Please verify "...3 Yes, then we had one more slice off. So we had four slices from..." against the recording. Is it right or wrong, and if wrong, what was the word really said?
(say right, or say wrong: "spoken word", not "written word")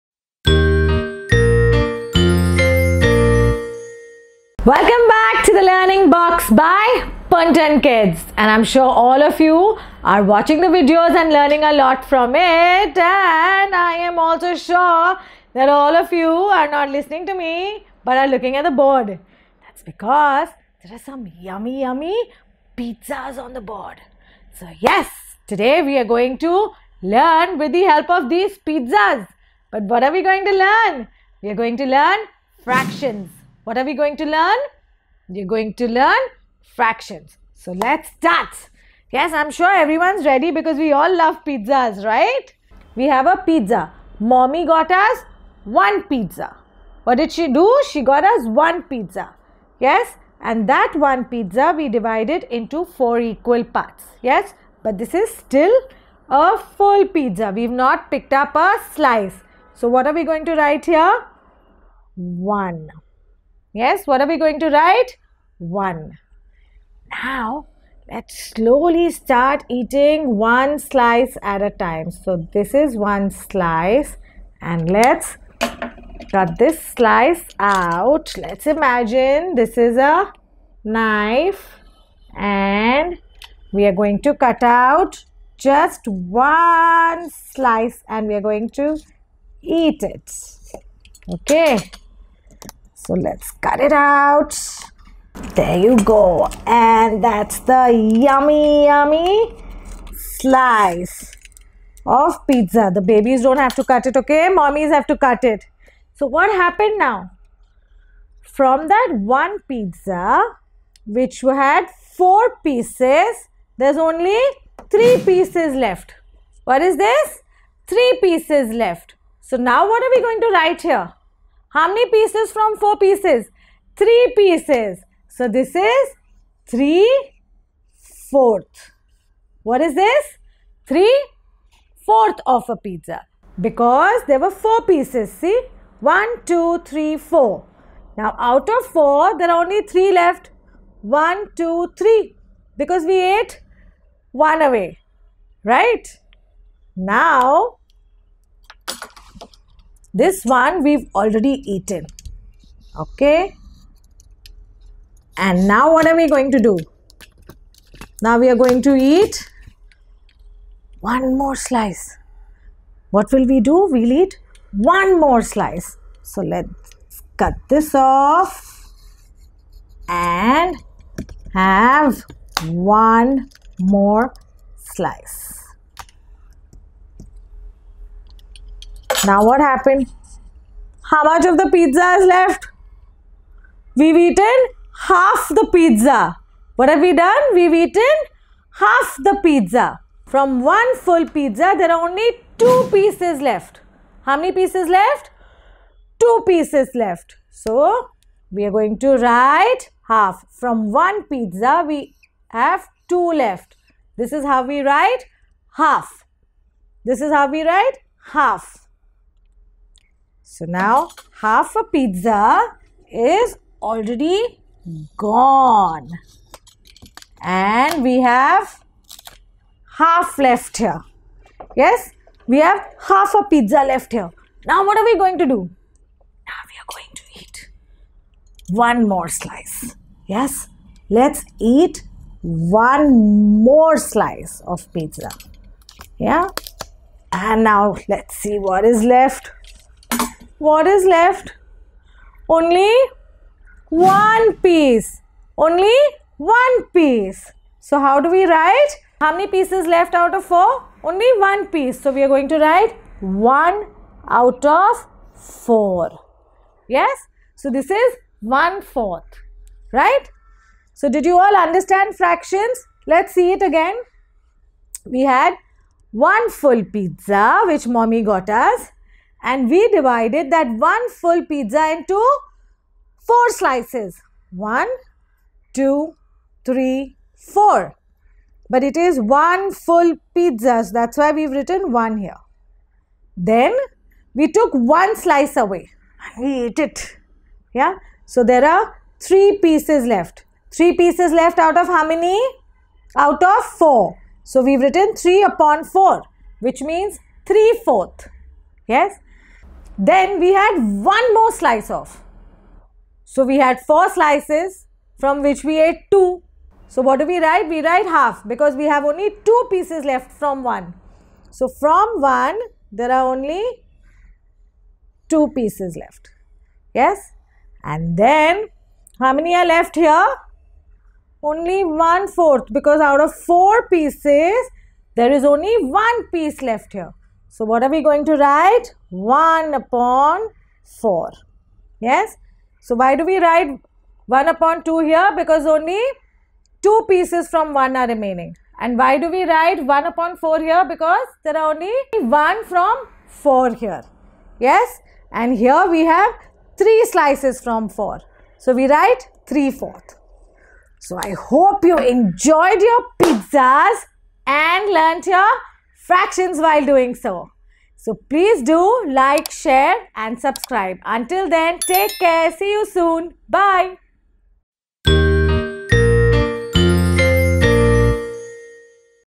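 right.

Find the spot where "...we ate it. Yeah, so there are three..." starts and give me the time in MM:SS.
04:46.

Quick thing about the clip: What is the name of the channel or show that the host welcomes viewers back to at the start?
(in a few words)
Learning Box.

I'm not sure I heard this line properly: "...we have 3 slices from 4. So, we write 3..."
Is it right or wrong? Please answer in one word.
right.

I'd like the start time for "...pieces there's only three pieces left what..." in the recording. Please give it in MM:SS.
01:52.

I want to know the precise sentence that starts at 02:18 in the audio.
Now out of 4 there are only 3 left.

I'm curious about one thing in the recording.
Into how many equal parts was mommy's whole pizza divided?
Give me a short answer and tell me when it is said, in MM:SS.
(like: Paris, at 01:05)
4, at 00:52.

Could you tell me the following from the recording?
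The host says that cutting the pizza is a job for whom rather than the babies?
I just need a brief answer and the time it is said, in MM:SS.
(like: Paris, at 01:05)
mommies, at 01:44.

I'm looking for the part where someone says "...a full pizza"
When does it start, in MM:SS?
00:56.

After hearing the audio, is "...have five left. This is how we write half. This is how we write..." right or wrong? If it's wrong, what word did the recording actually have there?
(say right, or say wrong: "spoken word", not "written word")
wrong: "two", not "five".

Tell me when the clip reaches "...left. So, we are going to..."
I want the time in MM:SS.
03:16.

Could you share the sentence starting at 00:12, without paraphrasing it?
And I am also sure that all of you are not listening to me but are looking at the board.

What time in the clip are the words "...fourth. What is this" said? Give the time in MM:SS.
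02:08.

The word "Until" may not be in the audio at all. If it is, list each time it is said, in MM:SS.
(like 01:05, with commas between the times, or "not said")
06:01.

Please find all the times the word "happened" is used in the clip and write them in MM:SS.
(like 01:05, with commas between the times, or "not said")
01:46, 02:59.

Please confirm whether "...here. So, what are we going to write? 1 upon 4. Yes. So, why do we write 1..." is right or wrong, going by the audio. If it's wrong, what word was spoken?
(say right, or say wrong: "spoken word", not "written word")
right.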